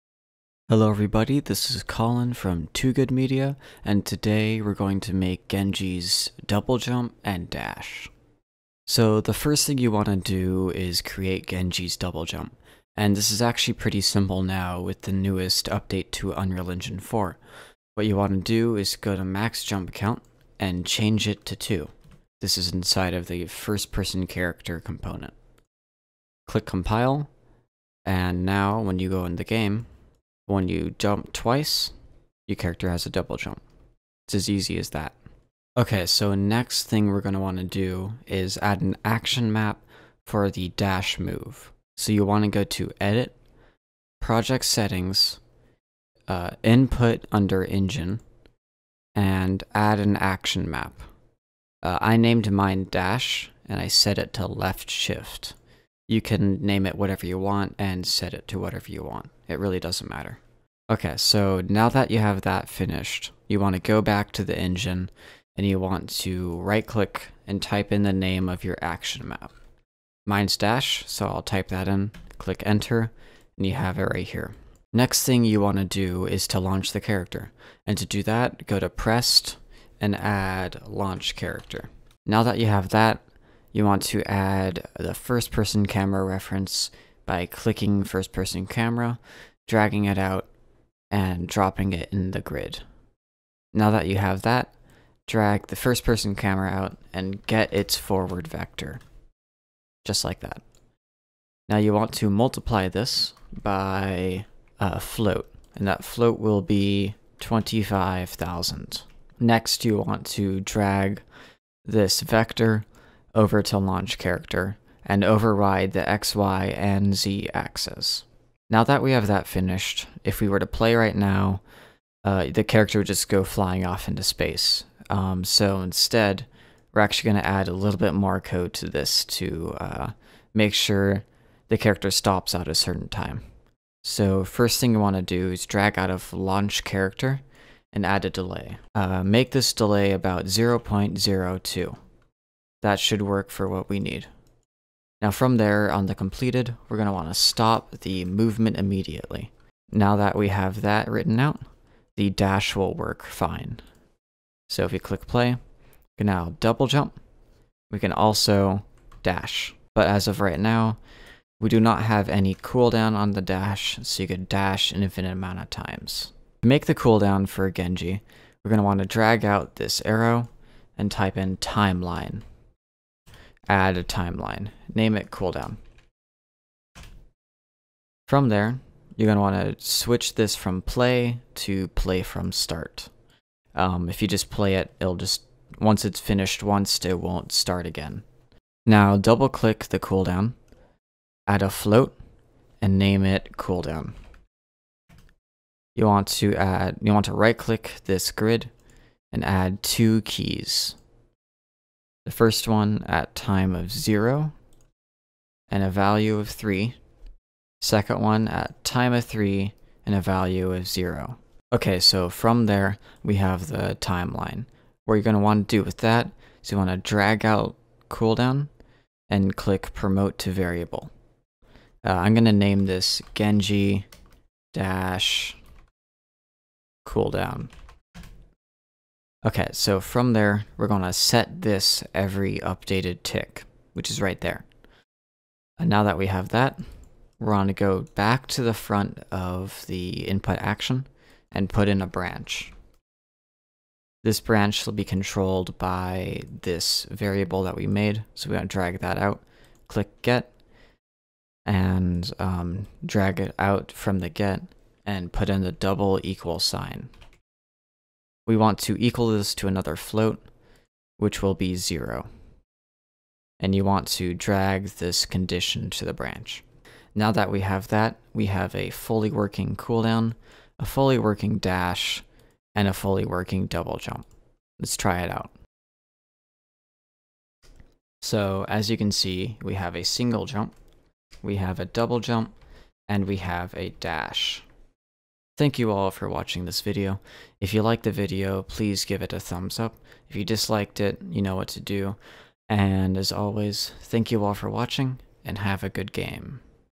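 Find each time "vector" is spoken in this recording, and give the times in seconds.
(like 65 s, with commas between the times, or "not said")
98 s, 112 s.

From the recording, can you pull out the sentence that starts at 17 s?
What you want to do is go to max jump Count and change it to 2.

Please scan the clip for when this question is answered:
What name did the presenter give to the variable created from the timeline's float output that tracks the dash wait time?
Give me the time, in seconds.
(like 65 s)
223 s.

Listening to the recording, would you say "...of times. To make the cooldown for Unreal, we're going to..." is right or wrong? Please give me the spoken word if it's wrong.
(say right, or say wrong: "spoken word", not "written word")
wrong: "Genji", not "Unreal".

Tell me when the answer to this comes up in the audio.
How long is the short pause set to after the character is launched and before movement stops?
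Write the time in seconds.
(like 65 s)
140 s.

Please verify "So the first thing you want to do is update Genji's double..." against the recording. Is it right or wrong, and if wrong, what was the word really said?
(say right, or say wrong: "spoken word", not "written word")
wrong: "create", not "update".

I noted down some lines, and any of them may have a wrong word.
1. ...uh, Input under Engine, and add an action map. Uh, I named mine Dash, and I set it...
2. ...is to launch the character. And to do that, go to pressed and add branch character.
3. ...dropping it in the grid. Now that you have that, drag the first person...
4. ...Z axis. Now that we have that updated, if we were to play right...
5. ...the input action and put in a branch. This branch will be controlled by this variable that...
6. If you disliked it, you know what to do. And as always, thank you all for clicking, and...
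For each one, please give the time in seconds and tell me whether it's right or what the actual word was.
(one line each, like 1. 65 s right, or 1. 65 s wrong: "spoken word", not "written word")
1. 46 s right
2. 76 s wrong: "launch", not "branch"
3. 91 s right
4. 117 s wrong: "finished", not "updated"
5. 239 s right
6. 290 s wrong: "watching", not "clicking".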